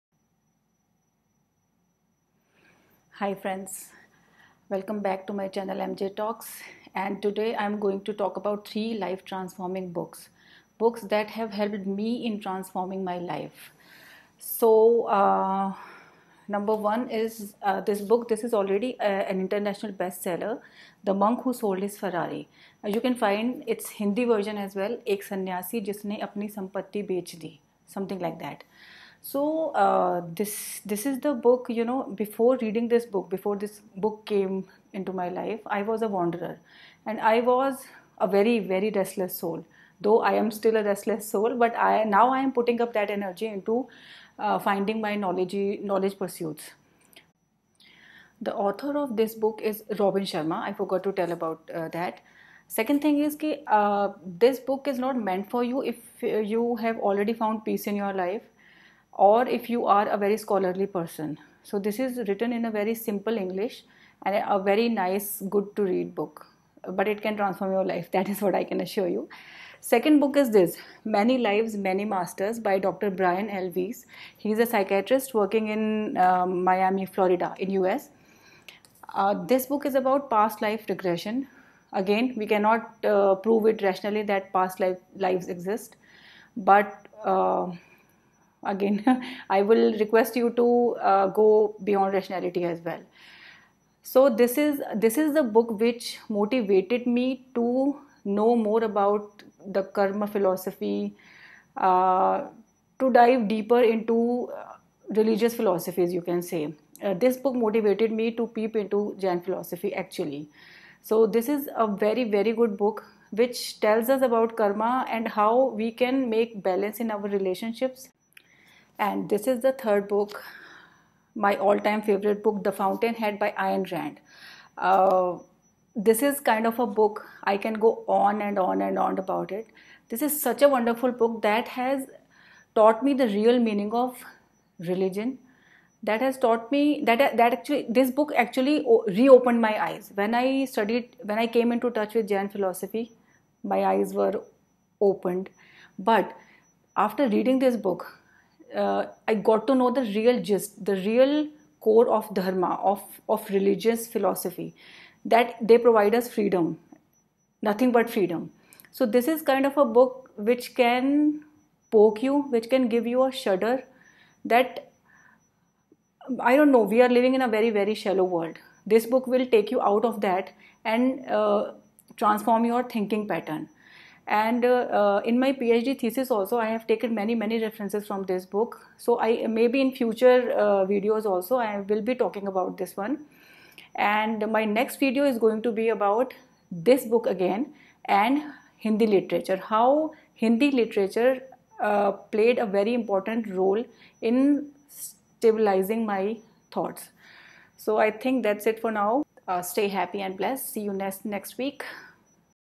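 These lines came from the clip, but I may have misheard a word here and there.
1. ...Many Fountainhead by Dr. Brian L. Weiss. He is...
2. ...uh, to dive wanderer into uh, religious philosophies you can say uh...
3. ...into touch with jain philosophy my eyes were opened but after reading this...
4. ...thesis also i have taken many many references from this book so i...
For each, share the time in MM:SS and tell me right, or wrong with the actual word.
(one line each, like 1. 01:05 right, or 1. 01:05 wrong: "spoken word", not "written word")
1. 01:11 wrong: "Masters", not "Fountainhead"
2. 01:41 wrong: "deeper", not "wanderer"
3. 02:21 right
4. 02:55 right.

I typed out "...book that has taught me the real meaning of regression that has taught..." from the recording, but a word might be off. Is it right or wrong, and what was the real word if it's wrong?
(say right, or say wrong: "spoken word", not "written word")
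wrong: "religion", not "regression".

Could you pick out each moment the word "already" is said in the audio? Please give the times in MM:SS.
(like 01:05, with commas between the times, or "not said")
00:18, 00:57.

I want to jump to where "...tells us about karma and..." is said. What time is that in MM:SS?
01:53.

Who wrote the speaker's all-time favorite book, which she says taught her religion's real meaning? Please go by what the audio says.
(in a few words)
Ayn Rand.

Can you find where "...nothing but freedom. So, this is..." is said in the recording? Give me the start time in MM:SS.
02:37.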